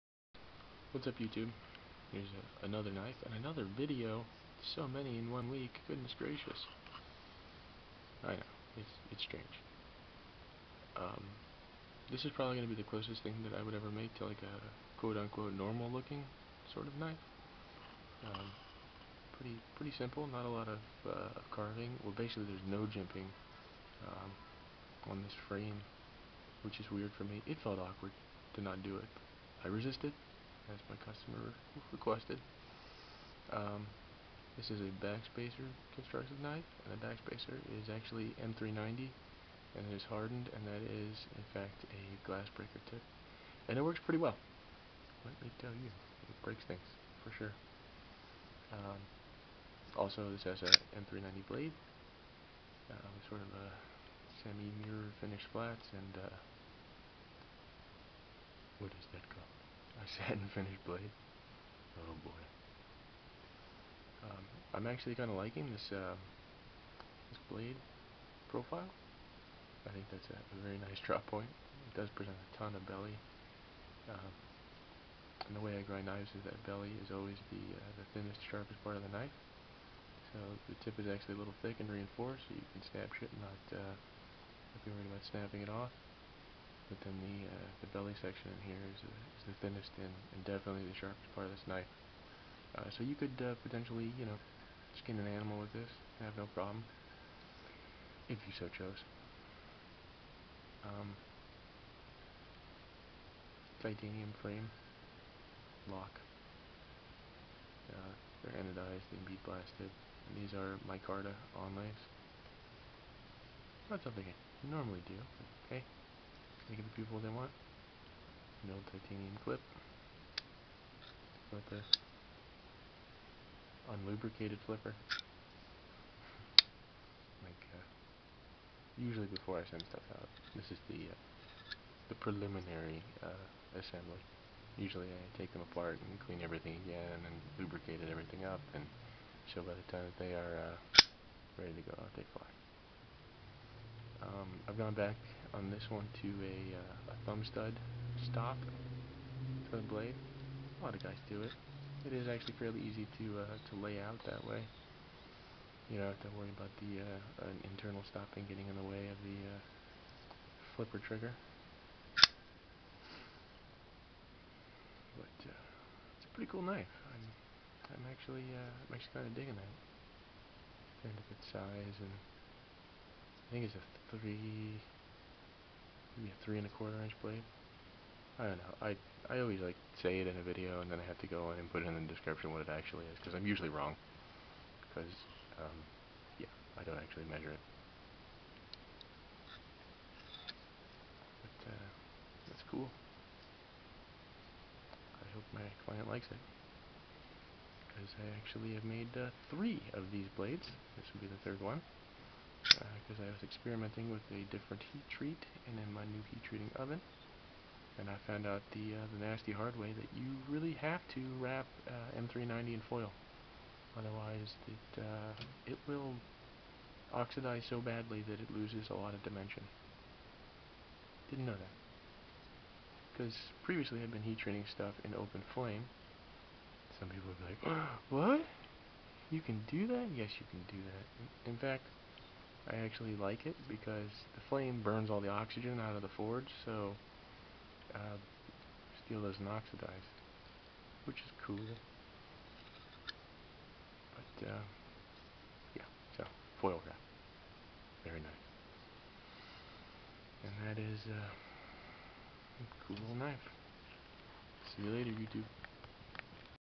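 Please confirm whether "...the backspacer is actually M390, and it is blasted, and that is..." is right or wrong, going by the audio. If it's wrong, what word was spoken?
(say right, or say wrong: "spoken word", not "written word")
wrong: "hardened", not "blasted".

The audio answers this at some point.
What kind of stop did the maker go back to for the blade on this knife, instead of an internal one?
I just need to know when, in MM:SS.
02:27.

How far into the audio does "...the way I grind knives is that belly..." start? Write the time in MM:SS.
01:15.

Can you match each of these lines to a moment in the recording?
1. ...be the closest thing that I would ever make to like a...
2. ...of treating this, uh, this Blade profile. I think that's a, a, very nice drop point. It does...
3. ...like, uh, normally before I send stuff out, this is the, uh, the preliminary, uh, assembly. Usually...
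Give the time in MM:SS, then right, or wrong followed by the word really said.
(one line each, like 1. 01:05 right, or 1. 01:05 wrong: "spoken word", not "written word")
1. 00:12 right
2. 01:05 wrong: "liking", not "treating"
3. 02:07 wrong: "usually", not "normally".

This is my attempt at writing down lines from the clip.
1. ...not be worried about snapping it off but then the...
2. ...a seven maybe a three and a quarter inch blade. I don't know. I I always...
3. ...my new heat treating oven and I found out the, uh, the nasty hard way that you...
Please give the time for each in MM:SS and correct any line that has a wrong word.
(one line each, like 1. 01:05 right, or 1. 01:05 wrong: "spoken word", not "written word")
1. 01:23 right
2. 02:53 wrong: "three", not "seven"
3. 03:25 right.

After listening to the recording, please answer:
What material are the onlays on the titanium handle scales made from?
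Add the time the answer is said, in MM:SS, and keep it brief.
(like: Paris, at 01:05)
Micarta, at 01:50.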